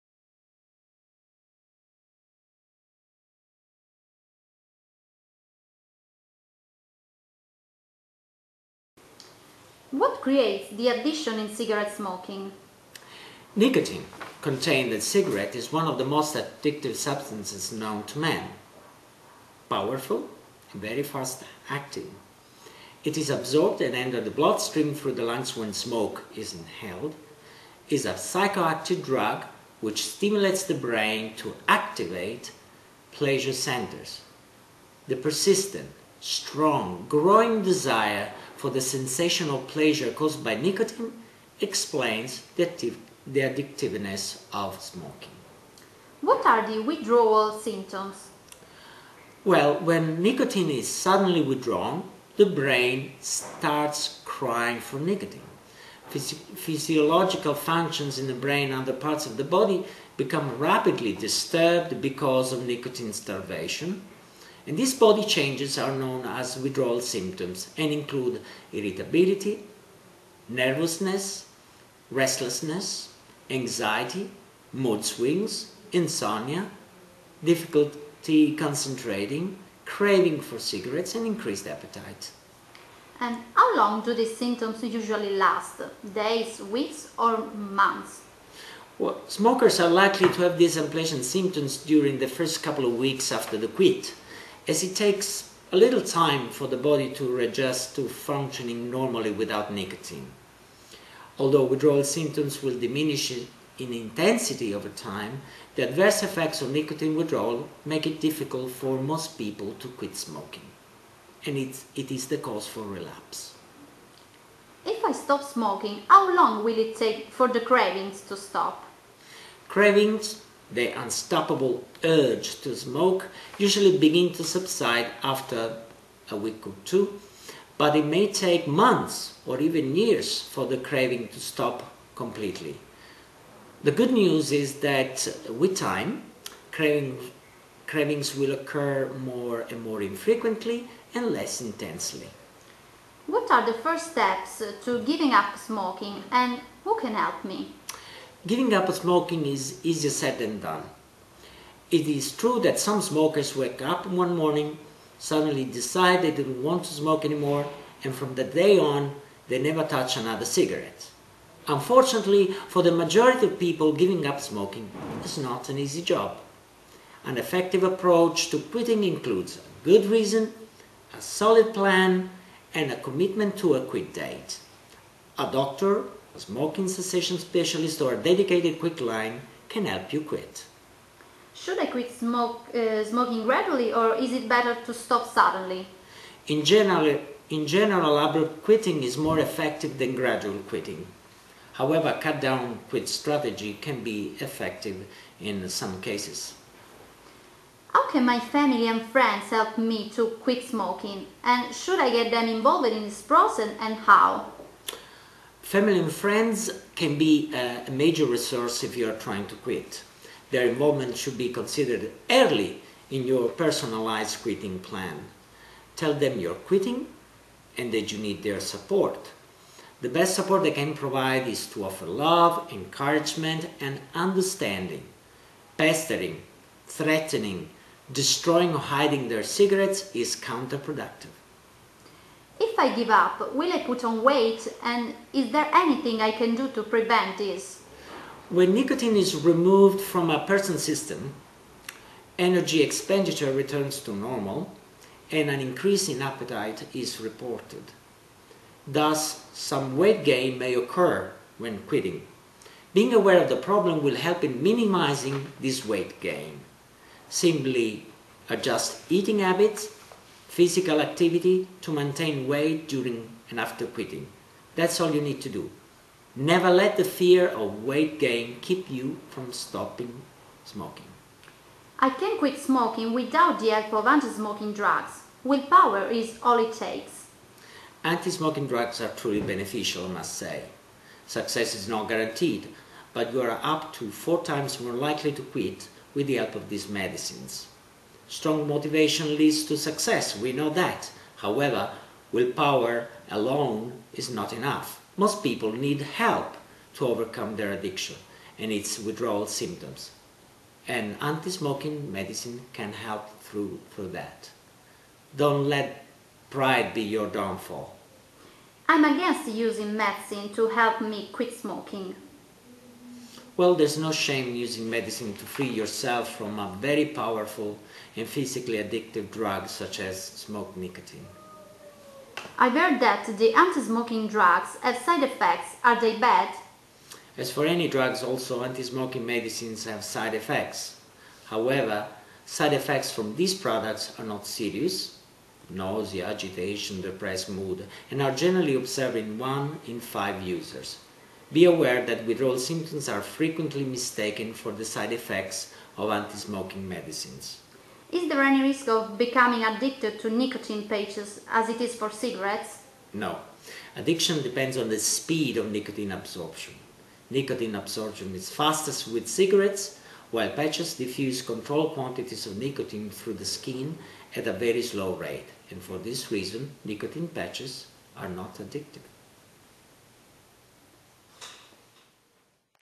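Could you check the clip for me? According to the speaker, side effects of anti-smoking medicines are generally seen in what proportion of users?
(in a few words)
1 in 5.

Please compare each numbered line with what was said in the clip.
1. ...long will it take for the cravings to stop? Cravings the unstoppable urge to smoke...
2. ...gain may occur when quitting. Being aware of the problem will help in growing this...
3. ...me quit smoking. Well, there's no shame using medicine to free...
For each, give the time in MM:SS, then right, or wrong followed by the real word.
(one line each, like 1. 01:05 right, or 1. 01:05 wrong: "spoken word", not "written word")
1. 01:56 right
2. 04:10 wrong: "minimizing", not "growing"
3. 05:11 right.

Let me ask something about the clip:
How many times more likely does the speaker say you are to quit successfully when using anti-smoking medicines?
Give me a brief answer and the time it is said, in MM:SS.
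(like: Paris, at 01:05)
4 times, at 04:44.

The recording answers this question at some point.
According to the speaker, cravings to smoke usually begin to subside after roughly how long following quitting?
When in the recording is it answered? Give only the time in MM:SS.
02:06.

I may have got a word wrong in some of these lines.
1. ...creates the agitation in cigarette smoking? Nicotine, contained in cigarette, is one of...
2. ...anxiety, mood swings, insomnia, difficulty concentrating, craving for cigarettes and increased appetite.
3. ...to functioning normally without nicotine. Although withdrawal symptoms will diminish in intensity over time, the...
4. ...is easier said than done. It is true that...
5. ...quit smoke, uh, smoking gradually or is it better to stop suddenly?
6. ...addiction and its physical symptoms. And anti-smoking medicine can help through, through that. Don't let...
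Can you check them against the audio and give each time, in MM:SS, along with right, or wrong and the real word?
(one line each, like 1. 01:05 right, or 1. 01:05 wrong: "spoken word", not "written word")
1. 00:10 wrong: "addiction", not "agitation"
2. 01:13 right
3. 01:37 right
4. 02:29 right
5. 03:01 right
6. 04:57 wrong: "withdrawal", not "physical".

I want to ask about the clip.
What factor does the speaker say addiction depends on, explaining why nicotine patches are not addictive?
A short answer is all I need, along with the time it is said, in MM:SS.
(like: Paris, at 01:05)
Speed of nicotine absorption, at 05:54.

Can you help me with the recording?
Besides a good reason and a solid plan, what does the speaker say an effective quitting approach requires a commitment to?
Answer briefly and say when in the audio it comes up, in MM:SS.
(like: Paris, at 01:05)
A quit date, at 02:53.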